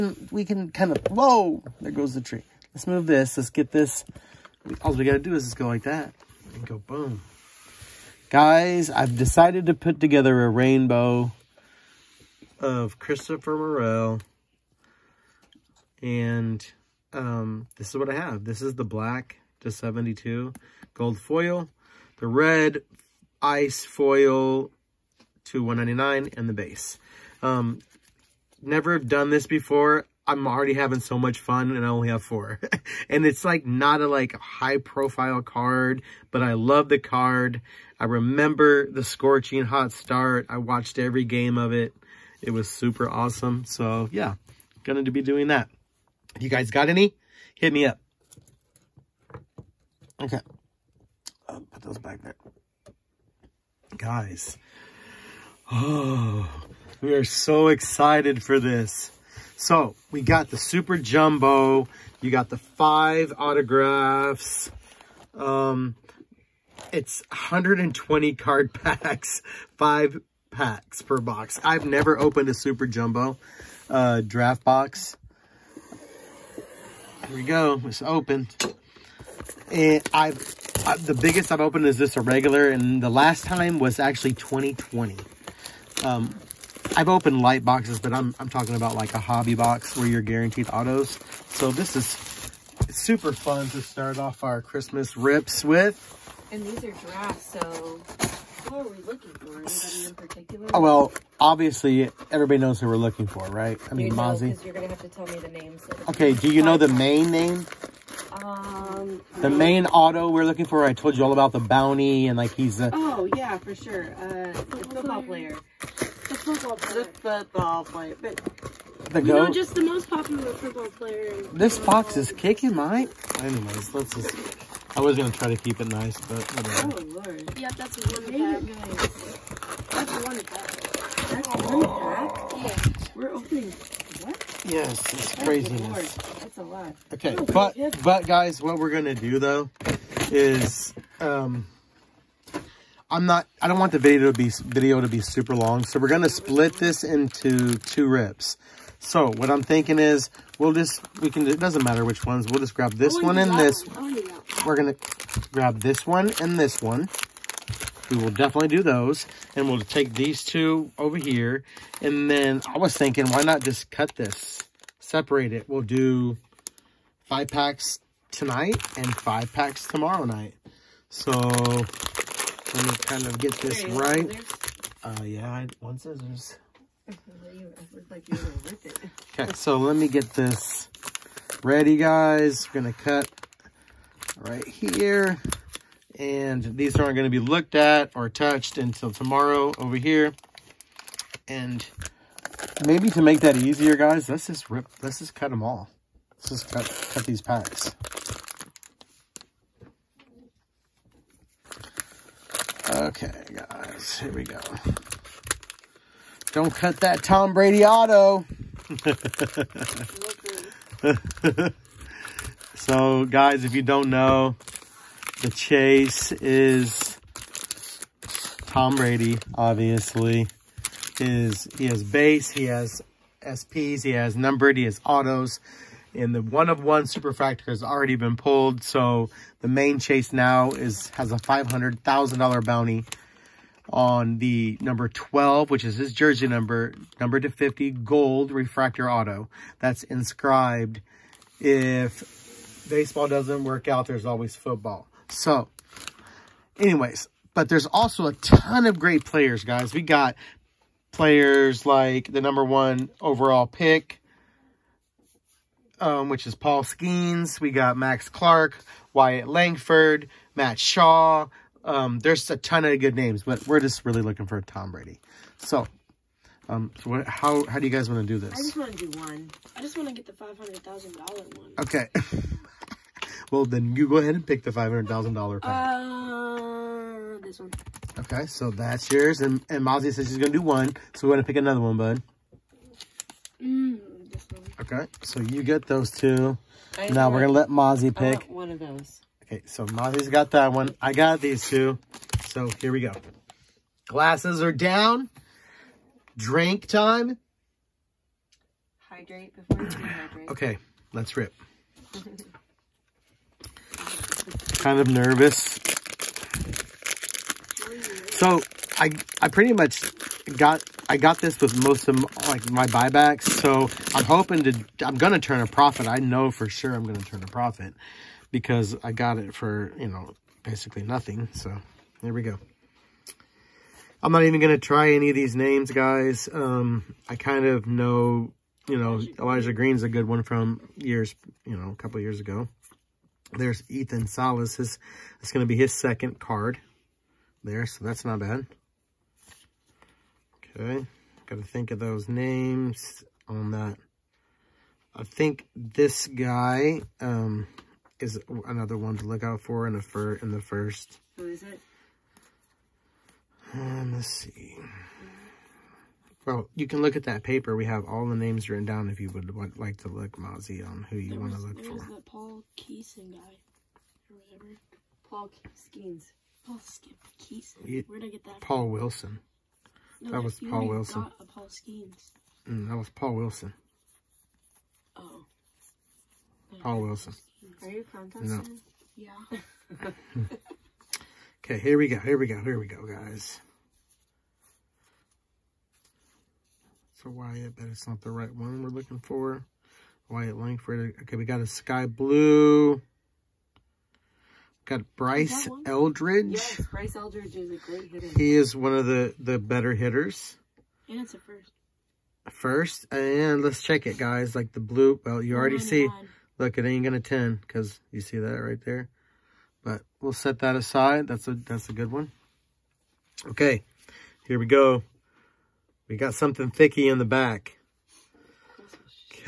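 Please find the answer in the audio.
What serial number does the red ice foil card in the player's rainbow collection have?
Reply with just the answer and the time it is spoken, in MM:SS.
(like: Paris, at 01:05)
199, at 00:25.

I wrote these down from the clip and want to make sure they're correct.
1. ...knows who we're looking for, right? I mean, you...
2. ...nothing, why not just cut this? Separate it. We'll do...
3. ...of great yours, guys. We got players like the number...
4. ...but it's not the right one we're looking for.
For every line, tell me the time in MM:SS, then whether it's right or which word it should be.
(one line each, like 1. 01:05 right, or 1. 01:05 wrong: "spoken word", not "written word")
1. 01:42 right
2. 02:42 wrong: "thinking", not "nothing"
3. 04:08 wrong: "players", not "yours"
4. 06:27 right.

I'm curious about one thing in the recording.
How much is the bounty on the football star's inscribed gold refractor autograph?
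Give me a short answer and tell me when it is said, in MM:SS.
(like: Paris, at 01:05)
$500,000, at 03:51.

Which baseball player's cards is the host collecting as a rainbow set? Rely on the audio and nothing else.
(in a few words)
Christopher Morel.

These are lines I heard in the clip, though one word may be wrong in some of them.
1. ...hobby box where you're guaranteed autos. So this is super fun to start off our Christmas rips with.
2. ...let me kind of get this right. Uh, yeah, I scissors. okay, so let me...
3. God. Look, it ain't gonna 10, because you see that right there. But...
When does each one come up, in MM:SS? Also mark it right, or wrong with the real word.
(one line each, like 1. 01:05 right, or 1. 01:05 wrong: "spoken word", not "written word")
1. 01:29 right
2. 02:52 right
3. 06:46 right.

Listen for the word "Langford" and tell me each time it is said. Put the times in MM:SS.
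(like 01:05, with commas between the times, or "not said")
04:19, 06:30.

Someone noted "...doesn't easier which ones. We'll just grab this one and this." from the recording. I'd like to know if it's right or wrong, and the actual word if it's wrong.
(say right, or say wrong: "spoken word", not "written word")
wrong: "matter", not "easier".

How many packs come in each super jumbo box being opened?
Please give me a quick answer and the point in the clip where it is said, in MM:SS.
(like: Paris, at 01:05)
5, at 01:09.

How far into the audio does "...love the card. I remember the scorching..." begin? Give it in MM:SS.
00:36.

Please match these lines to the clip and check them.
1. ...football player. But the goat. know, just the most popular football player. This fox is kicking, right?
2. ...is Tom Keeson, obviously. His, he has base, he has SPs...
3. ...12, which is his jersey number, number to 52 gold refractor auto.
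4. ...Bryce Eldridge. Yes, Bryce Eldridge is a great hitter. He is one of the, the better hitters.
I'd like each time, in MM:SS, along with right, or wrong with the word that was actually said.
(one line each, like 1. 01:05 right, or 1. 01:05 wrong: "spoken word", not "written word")
1. 01:57 right
2. 03:36 wrong: "Brady", not "Keeson"
3. 03:55 wrong: "50", not "52"
4. 06:35 right.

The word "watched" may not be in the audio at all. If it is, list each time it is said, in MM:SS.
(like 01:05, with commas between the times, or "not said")
00:40.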